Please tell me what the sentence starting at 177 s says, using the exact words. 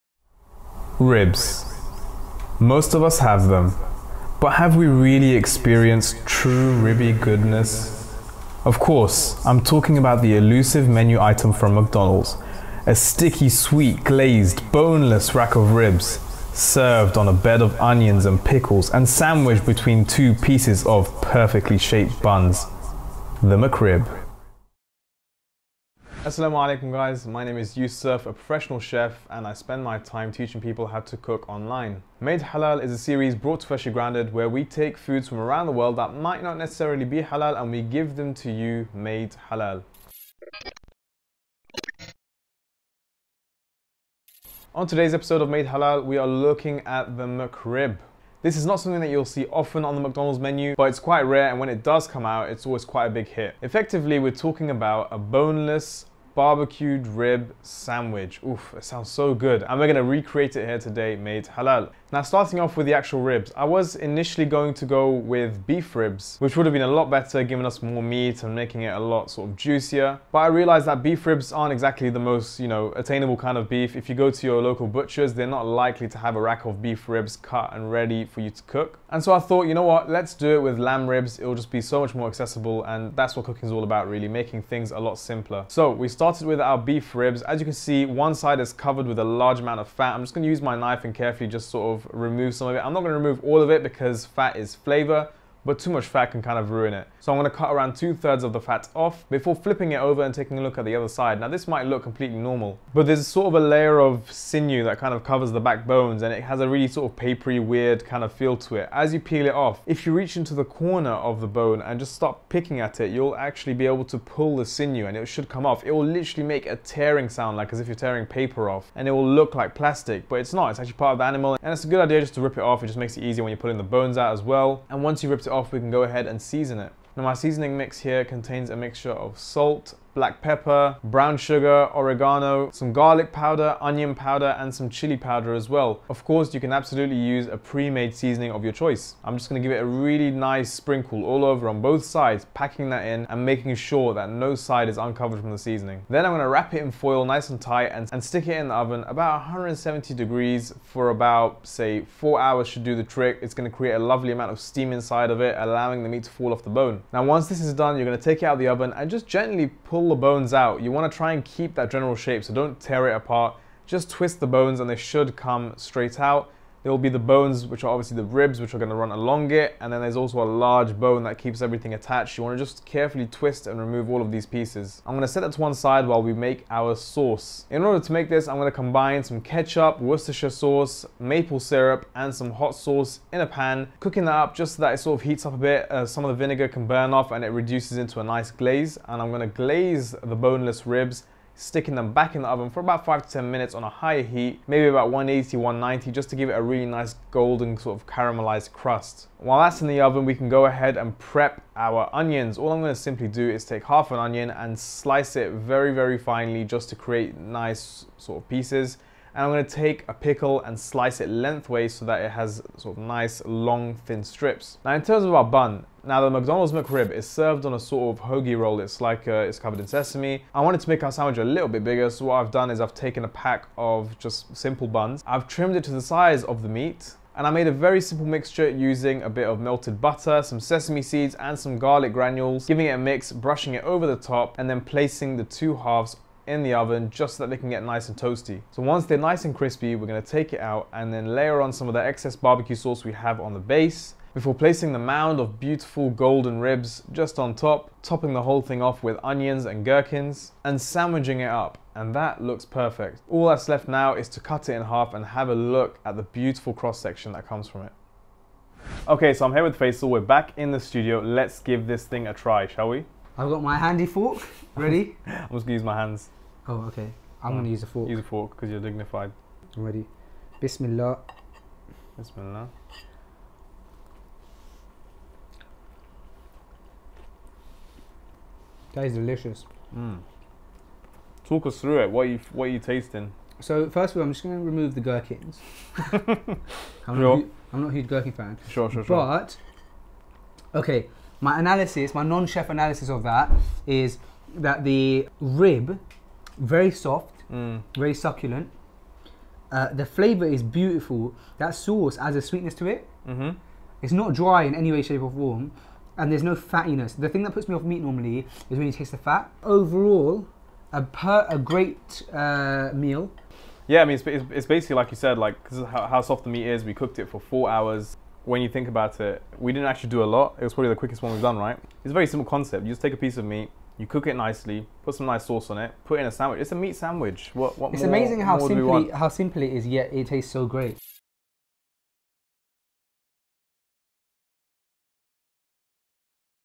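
In order to make this, I'm going to combine some ketchup, Worcestershire sauce, maple syrup, and some hot sauce in a pan.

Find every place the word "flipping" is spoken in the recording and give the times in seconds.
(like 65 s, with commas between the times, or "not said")
99 s.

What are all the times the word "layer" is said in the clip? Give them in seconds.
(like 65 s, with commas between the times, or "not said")
103 s, 241 s.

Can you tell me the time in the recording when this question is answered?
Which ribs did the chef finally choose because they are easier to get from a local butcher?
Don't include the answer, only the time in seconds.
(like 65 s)
80 s.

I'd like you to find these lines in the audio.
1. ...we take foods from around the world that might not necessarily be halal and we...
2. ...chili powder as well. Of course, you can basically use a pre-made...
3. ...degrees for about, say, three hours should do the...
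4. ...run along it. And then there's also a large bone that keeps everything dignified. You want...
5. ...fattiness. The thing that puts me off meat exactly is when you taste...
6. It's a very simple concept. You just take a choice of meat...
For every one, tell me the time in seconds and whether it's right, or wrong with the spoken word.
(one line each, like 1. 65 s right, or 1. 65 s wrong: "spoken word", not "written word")
1. 34 s right
2. 134 s wrong: "absolutely", not "basically"
3. 150 s wrong: "four", not "three"
4. 168 s wrong: "attached", not "dignified"
5. 306 s wrong: "normally", not "exactly"
6. 322 s wrong: "piece", not "choice".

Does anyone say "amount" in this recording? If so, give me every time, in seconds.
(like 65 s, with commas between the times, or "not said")
89 s, 154 s.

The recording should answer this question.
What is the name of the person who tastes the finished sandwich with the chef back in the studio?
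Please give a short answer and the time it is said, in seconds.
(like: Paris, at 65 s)
Faisal, at 259 s.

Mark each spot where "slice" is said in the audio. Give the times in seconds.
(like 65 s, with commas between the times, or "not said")
204 s, 210 s.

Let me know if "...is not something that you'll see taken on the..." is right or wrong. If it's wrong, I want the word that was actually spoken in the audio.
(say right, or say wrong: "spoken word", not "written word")
wrong: "often", not "taken".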